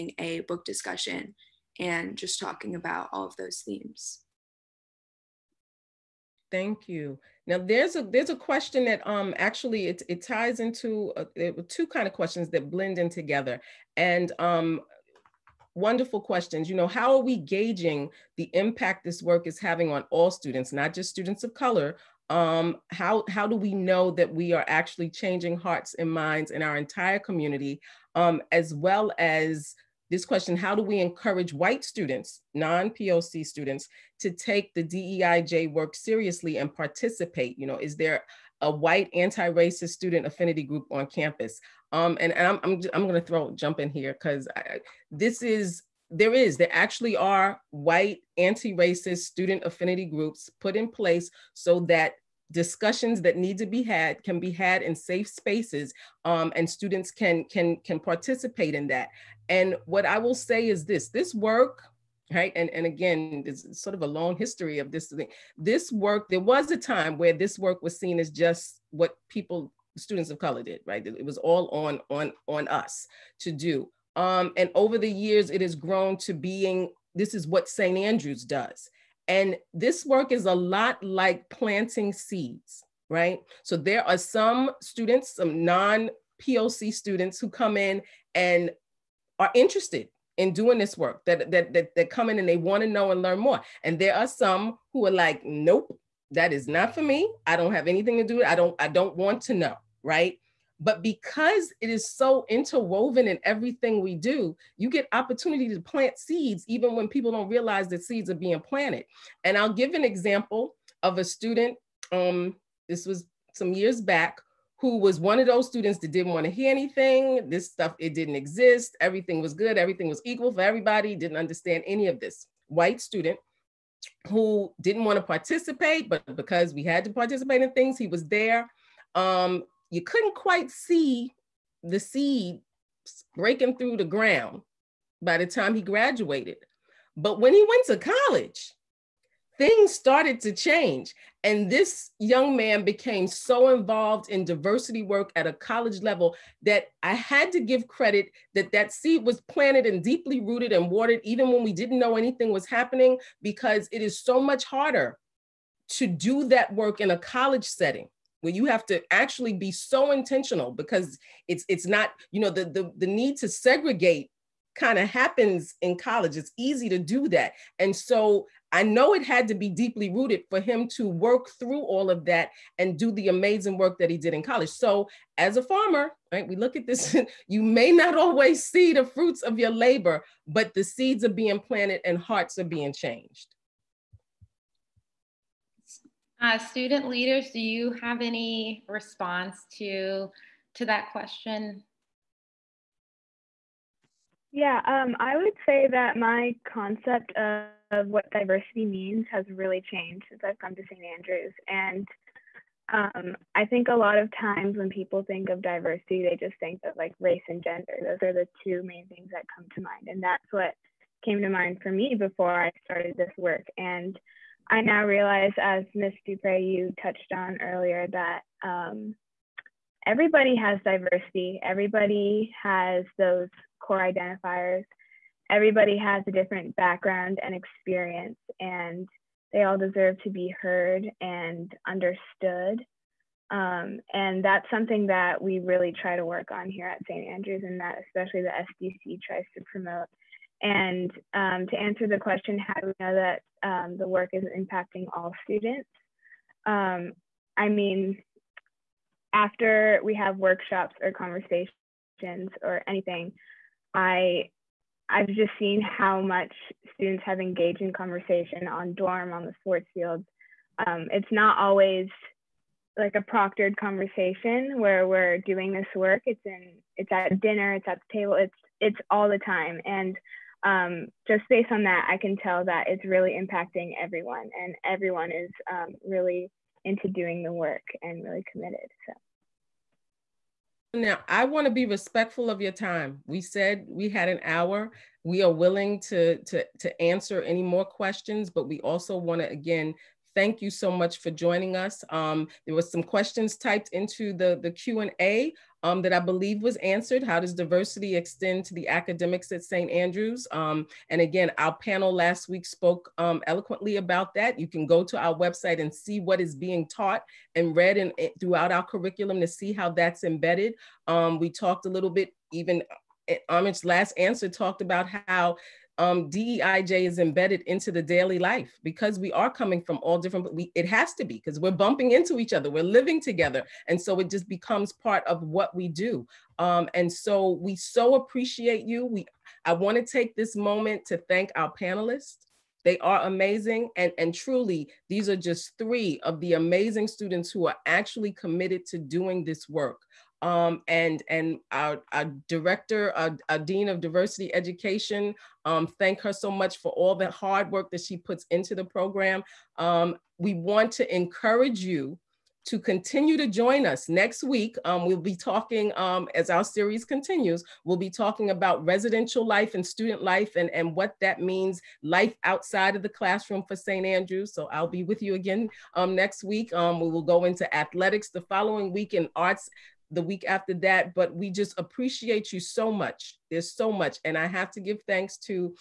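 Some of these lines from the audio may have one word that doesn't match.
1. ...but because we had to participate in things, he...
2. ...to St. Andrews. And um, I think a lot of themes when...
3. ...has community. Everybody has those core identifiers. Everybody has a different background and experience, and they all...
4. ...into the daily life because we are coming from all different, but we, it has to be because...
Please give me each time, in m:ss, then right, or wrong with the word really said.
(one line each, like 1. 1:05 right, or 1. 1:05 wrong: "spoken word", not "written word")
1. 2:06 right
2. 3:20 wrong: "times", not "themes"
3. 3:40 wrong: "diversity", not "community"
4. 5:17 right.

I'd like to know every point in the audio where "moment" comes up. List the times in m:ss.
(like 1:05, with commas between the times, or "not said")
5:30.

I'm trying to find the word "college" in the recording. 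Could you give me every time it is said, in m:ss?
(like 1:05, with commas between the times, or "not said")
2:18, 2:25, 2:37, 2:45, 2:54.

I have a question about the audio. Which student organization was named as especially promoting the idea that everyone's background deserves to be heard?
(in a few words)
SDC.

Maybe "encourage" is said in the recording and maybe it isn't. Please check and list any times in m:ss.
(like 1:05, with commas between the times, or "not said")
0:30, 5:51.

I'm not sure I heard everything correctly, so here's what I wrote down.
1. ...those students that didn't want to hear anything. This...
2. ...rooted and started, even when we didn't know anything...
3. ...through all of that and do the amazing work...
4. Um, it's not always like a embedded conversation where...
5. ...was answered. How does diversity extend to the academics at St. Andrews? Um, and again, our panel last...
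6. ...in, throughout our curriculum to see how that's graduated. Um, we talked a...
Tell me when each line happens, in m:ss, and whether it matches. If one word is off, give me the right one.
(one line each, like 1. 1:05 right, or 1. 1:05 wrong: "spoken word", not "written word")
1. 1:55 right
2. 2:30 wrong: "watered", not "started"
3. 2:51 right
4. 4:20 wrong: "proctored", not "embedded"
5. 4:56 right
6. 5:07 wrong: "embedded", not "graduated".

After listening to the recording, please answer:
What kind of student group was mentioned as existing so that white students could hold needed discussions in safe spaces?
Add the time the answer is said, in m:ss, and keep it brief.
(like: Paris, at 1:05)
White anti-racist student affinity groups, at 0:47.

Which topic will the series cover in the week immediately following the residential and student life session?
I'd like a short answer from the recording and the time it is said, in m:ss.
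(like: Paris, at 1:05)
Athletics, at 6:07.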